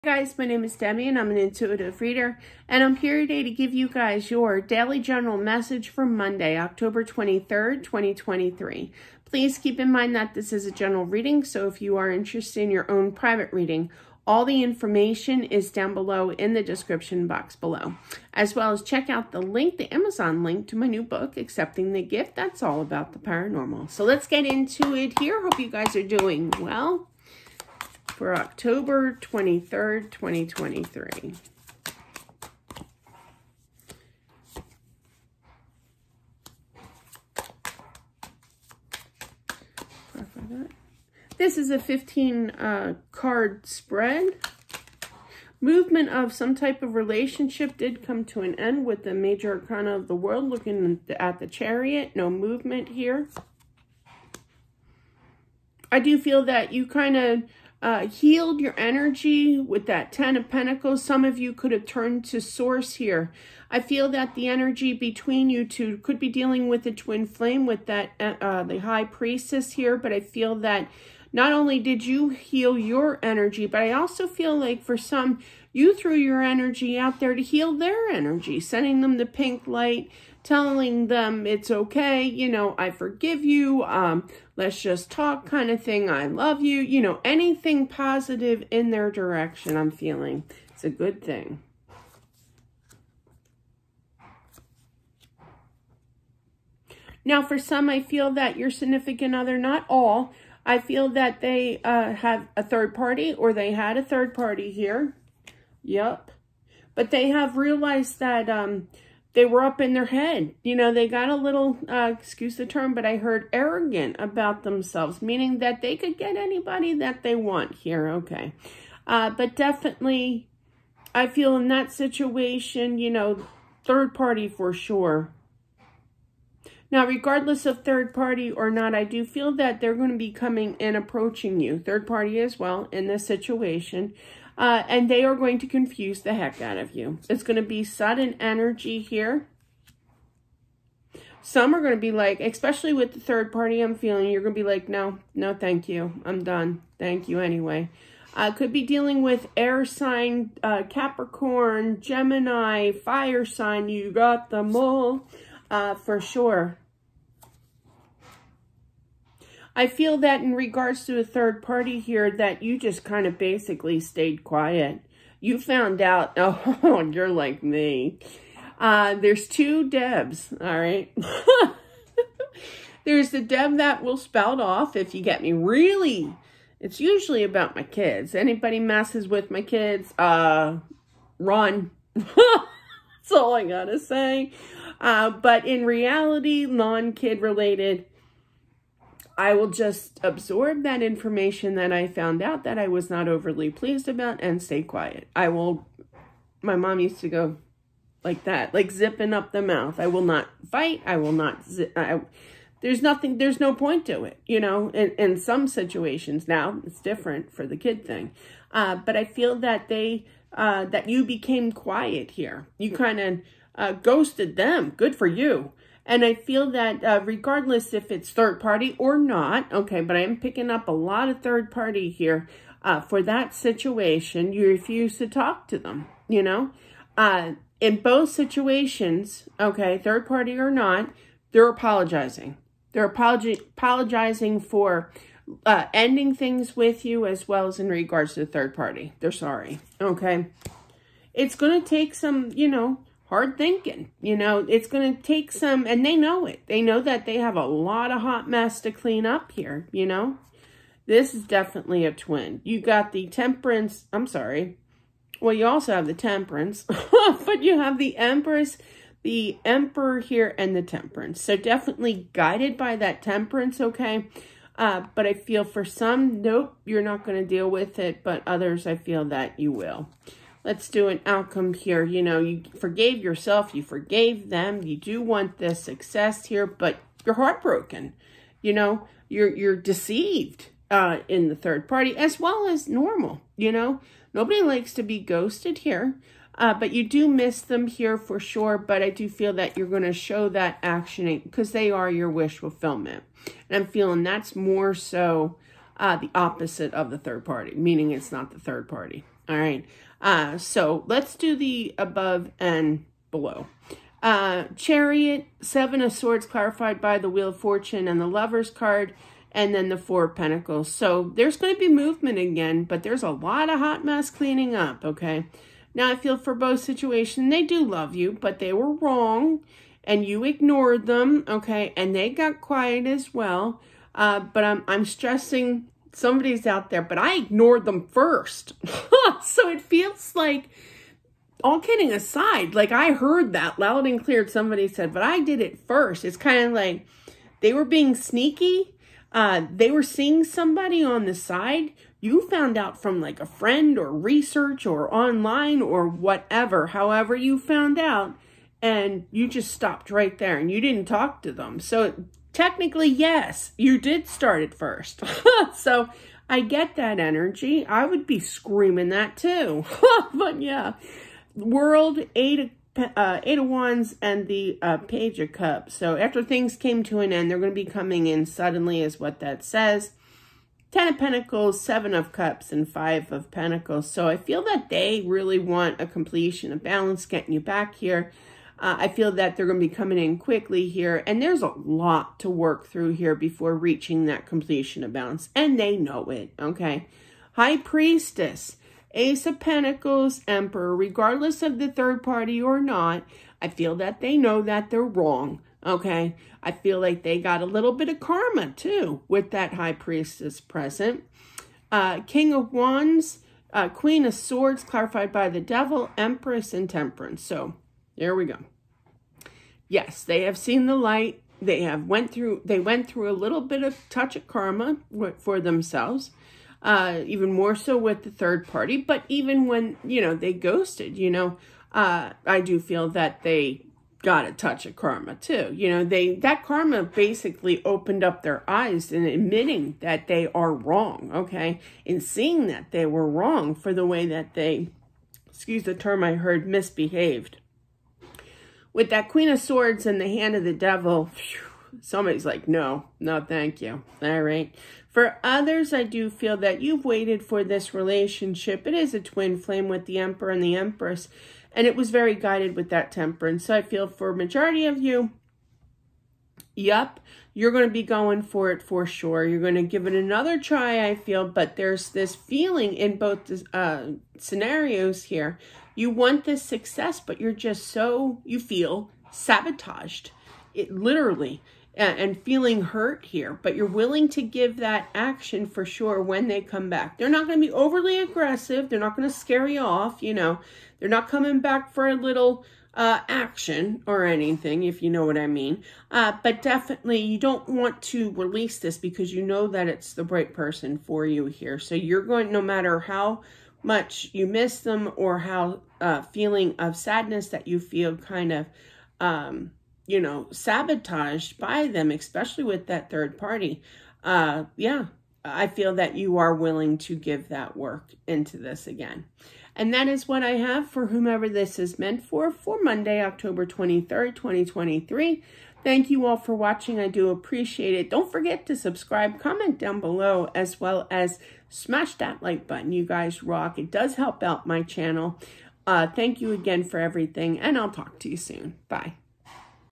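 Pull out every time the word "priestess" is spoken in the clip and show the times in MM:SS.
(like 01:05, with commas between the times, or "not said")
01:09, 06:27, 06:39.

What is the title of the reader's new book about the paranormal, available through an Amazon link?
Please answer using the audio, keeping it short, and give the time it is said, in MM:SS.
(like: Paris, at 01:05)
Accepting the Gift, at 00:21.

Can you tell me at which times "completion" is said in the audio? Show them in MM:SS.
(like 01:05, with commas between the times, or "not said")
06:16, 06:24.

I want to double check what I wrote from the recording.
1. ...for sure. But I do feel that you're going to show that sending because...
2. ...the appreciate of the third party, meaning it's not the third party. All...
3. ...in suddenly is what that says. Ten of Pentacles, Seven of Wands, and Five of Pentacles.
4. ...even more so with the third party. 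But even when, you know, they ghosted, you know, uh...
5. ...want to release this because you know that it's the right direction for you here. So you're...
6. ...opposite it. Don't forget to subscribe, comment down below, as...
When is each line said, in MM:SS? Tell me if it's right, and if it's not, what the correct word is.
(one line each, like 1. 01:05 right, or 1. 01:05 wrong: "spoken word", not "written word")
1. 04:48 wrong: "actioning", not "sending"
2. 04:56 wrong: "opposite", not "appreciate"
3. 06:08 wrong: "Cups", not "Wands"
4. 06:57 right
5. 08:07 wrong: "person", not "direction"
6. 08:37 wrong: "appreciate", not "opposite".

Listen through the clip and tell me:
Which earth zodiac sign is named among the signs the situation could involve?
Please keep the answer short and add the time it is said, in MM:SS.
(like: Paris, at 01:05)
Capricorn, at 02:30.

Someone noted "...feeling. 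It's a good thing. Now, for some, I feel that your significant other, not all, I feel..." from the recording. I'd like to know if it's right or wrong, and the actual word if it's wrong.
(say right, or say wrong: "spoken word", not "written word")
right.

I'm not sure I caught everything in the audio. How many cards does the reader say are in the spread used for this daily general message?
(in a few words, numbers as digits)
15.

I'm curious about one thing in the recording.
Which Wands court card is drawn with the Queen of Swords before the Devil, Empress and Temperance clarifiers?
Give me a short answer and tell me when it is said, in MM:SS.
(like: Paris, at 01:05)
King of Wands, at 06:42.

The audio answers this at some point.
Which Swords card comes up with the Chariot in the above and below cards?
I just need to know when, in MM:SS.
05:05.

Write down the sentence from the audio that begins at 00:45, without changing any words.
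Movement of some type of relationship did come to an end with the major arcana of the world, looking at the chariot.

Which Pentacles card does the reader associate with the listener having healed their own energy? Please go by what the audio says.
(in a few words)
10 of Pentacles.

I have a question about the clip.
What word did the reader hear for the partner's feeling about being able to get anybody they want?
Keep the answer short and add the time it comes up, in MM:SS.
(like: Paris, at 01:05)
arrogant, at 01:53.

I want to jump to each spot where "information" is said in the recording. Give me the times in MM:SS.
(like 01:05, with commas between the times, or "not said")
00:14, 03:11.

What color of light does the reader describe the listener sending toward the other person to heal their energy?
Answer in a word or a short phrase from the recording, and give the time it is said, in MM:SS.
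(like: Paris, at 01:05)
pink, at 01:19.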